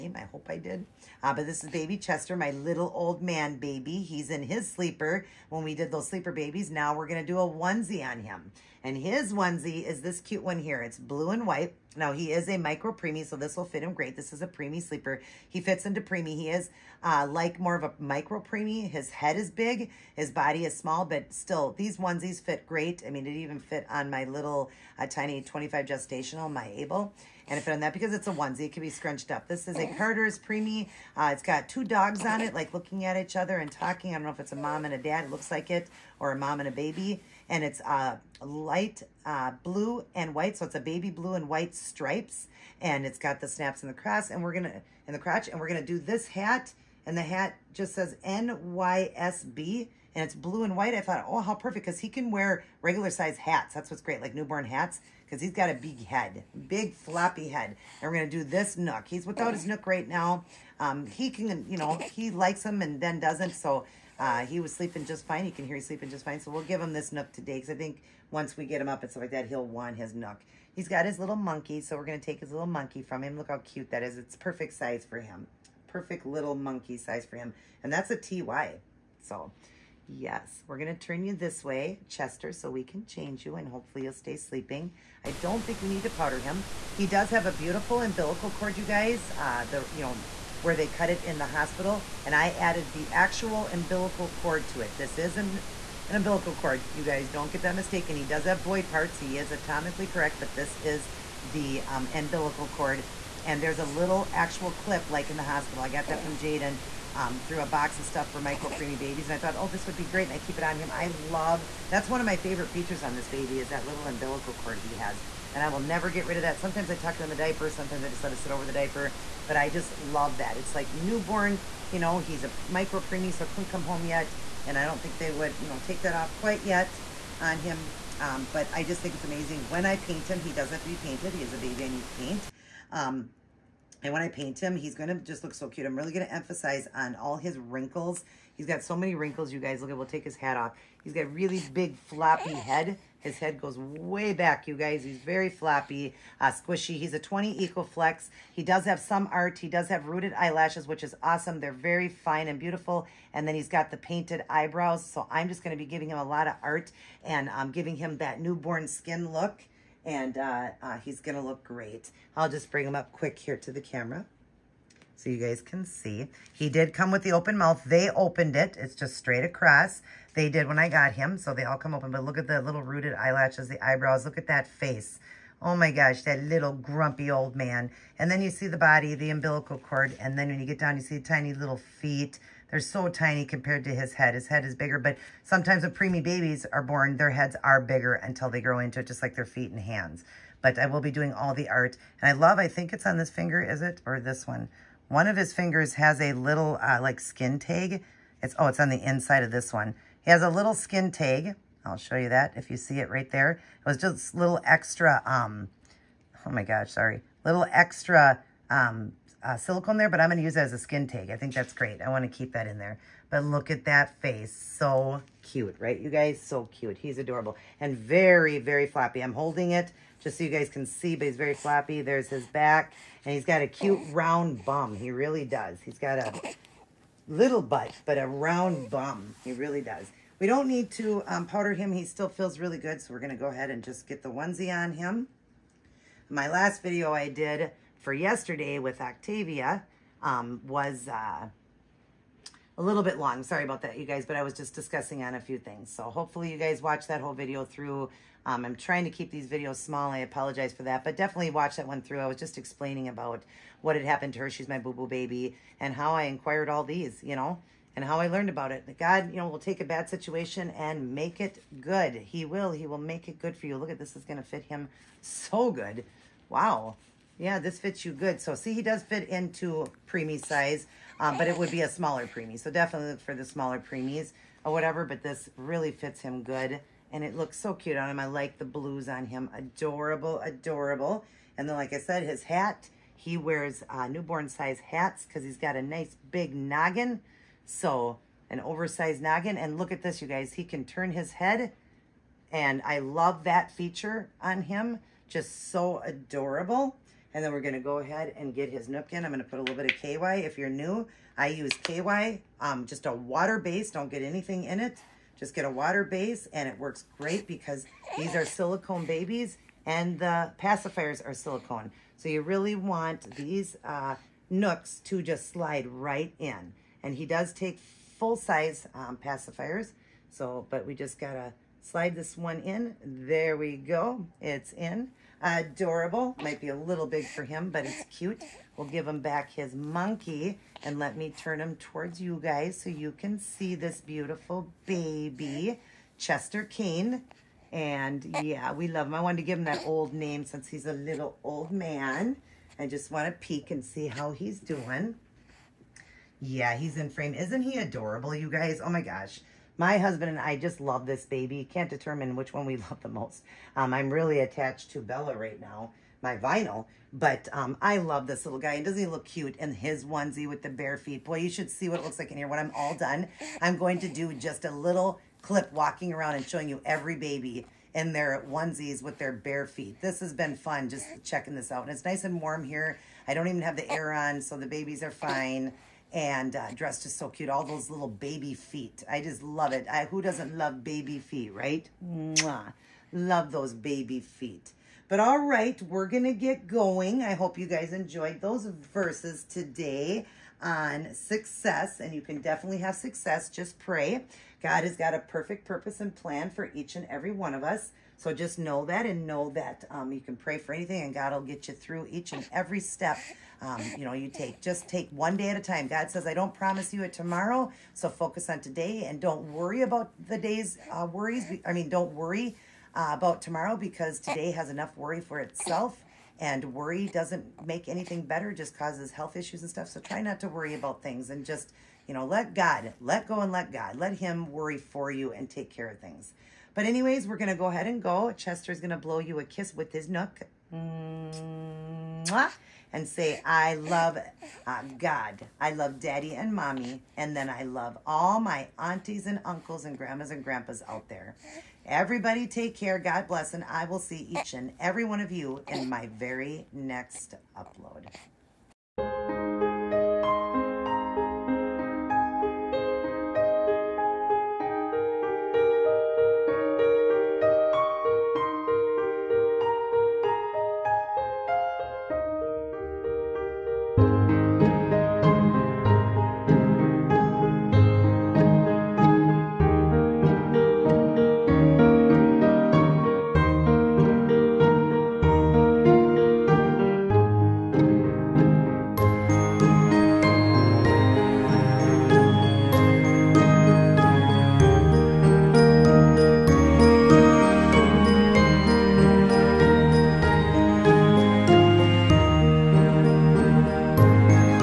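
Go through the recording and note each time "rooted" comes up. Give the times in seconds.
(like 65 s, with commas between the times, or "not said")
150 s, 172 s.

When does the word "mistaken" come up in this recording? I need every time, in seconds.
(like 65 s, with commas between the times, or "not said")
97 s.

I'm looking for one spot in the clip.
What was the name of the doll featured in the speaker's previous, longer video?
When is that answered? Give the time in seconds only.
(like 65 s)
239 s.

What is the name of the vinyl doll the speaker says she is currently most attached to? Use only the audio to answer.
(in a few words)
Bella.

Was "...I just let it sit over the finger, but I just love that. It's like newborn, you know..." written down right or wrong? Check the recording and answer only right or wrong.
wrong.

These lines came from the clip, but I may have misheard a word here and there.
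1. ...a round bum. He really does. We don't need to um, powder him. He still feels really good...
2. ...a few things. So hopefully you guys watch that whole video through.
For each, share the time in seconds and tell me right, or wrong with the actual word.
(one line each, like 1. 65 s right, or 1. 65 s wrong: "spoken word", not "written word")
1. 228 s right
2. 245 s right.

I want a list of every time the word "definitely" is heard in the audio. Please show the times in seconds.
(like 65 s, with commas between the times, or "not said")
251 s, 272 s, 392 s.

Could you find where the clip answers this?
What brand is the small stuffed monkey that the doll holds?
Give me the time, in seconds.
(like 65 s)
78 s.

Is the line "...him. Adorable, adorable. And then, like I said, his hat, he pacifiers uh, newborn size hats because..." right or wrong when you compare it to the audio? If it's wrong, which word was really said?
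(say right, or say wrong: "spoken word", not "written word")
wrong: "wears", not "pacifiers".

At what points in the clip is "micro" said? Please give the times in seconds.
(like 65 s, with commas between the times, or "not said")
12 s, 17 s, 108 s, 122 s.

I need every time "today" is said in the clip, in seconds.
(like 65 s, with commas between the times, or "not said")
67 s, 389 s, 408 s, 414 s.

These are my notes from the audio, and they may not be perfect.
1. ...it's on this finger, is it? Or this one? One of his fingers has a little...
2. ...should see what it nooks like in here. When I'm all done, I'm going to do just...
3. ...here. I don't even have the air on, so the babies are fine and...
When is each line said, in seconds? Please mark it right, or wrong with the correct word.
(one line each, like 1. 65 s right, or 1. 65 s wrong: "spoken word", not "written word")
1. 192 s right
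2. 361 s wrong: "looks", not "nooks"
3. 372 s right.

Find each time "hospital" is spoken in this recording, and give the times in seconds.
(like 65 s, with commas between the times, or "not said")
91 s, 105 s.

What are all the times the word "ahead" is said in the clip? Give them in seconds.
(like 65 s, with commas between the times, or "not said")
233 s, 297 s, 427 s.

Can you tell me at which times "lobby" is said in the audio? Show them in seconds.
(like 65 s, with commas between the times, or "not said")
not said.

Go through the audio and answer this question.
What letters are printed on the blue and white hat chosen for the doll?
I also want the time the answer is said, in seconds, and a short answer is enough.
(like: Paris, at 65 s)
NYSB, at 48 s.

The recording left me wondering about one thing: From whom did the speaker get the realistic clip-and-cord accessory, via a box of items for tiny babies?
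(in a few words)
Jaden.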